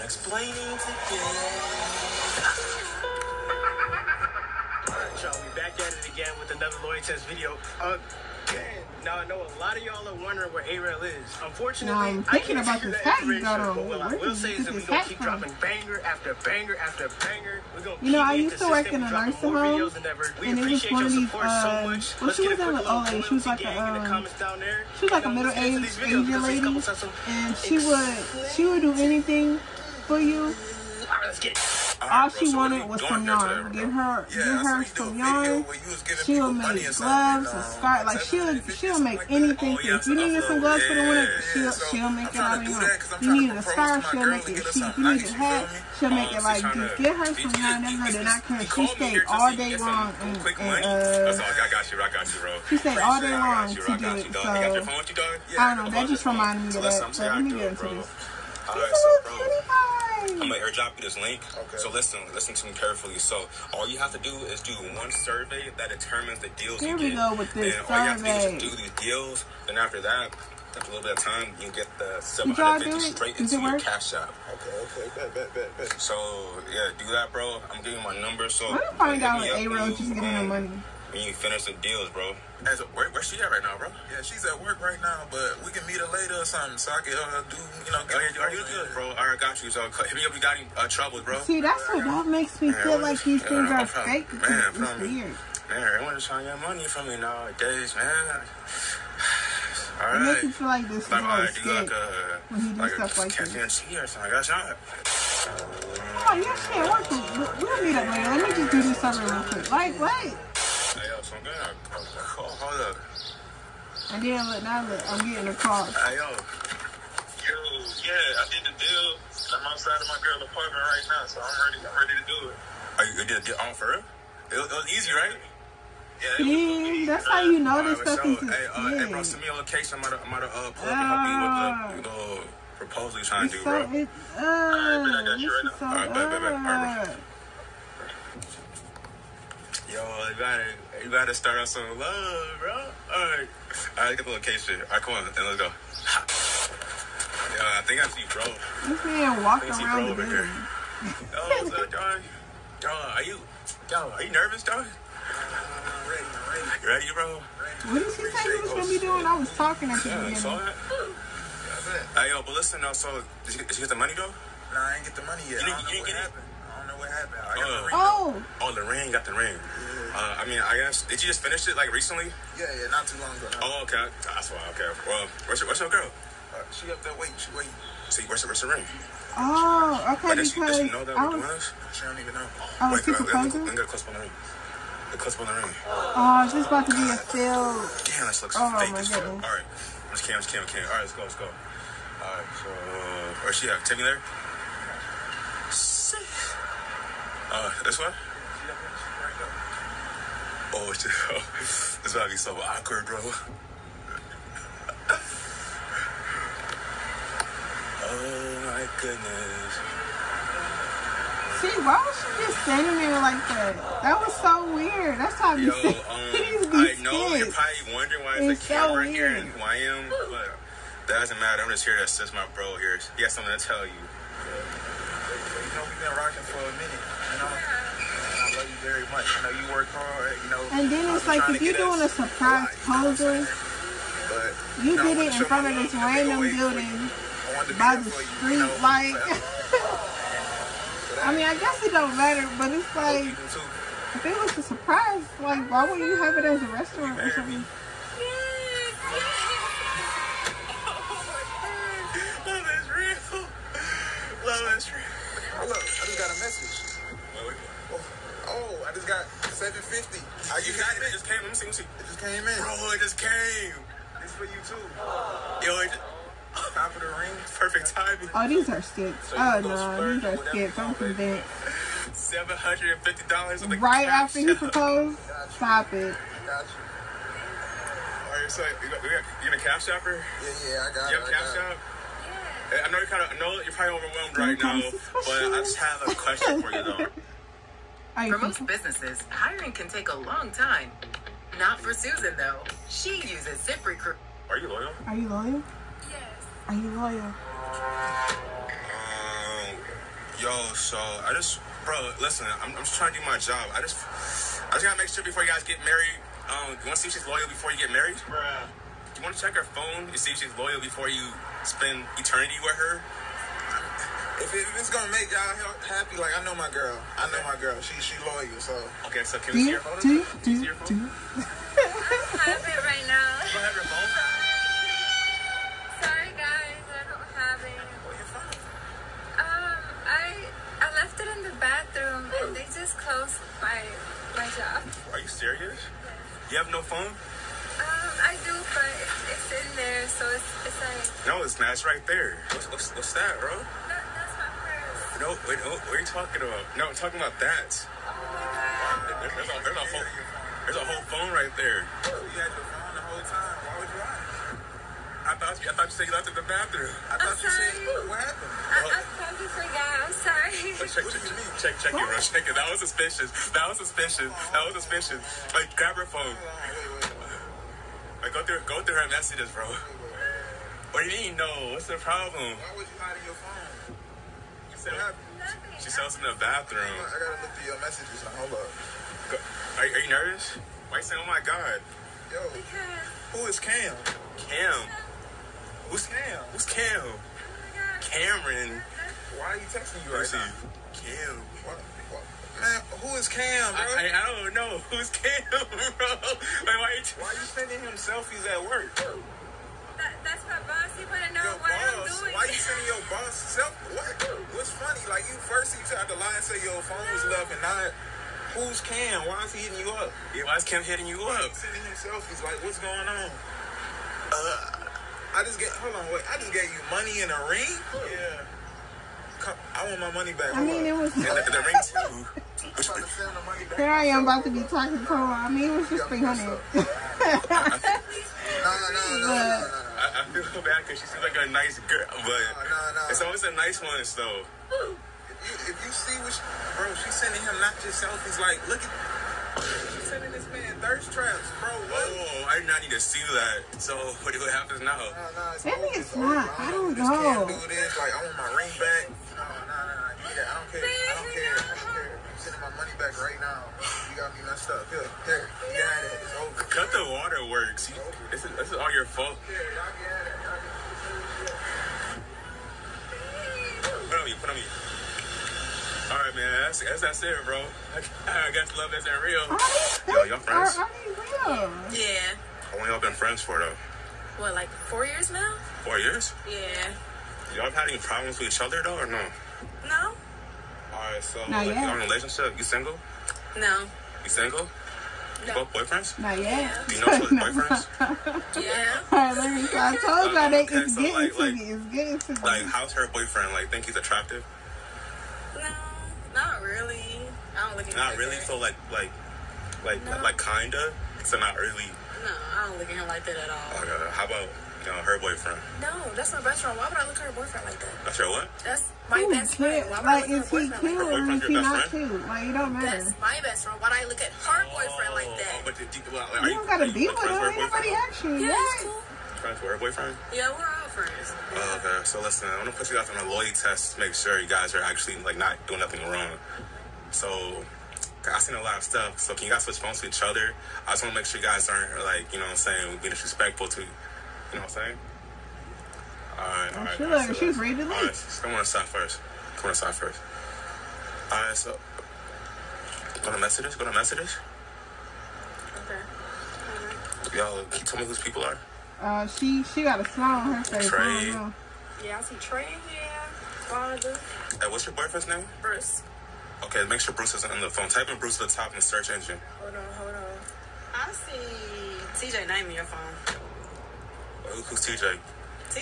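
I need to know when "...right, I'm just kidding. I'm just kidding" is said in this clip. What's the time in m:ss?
3:09.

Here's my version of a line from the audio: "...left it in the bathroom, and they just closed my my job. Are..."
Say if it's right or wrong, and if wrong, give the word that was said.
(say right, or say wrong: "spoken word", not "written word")
right.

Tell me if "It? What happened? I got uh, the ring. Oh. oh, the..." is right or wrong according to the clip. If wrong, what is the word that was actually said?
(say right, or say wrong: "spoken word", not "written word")
right.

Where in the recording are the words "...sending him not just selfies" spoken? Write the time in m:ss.
7:17.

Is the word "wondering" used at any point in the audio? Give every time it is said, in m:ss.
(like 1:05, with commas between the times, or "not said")
0:10, 3:37.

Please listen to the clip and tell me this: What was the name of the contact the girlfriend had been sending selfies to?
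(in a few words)
Cameron.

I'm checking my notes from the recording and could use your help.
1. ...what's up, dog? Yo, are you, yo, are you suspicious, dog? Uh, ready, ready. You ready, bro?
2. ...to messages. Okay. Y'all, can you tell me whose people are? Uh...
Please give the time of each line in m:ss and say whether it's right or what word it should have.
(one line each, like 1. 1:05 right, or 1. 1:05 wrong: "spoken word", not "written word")
1. 2:31 wrong: "nervous", not "suspicious"
2. 9:03 right.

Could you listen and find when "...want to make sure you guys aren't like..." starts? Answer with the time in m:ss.
8:51.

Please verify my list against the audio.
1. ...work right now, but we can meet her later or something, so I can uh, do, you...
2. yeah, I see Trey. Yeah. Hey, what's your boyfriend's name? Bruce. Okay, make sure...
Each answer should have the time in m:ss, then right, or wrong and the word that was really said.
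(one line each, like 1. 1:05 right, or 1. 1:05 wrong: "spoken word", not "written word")
1. 1:24 right
2. 9:12 right.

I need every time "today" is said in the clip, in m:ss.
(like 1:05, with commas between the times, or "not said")
0:00.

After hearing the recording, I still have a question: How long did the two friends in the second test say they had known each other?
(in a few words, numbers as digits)
4 years.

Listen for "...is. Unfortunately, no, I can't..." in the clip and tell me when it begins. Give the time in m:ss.
0:11.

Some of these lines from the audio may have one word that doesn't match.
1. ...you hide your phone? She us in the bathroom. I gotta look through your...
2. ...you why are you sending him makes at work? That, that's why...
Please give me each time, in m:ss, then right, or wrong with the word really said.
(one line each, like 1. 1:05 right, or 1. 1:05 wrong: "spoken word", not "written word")
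1. 6:12 right
2. 6:36 wrong: "selfies", not "makes".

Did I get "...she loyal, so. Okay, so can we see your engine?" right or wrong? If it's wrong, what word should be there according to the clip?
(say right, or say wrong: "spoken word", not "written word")
wrong: "phone", not "engine".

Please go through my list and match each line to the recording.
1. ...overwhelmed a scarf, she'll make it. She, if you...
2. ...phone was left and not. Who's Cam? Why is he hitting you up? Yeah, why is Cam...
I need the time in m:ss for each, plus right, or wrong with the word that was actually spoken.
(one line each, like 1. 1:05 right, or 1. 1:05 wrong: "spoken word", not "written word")
1. 0:43 wrong: "needed", not "overwhelmed"
2. 6:46 right.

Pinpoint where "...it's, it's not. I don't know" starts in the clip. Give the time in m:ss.
7:25.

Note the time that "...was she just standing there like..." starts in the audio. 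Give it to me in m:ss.
3:31.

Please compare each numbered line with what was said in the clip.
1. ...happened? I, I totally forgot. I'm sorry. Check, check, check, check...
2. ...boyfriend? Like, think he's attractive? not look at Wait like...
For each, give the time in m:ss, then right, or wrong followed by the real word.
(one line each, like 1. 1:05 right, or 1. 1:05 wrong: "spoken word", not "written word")
1. 5:58 right
2. 8:13 wrong: "Not", not "Wait".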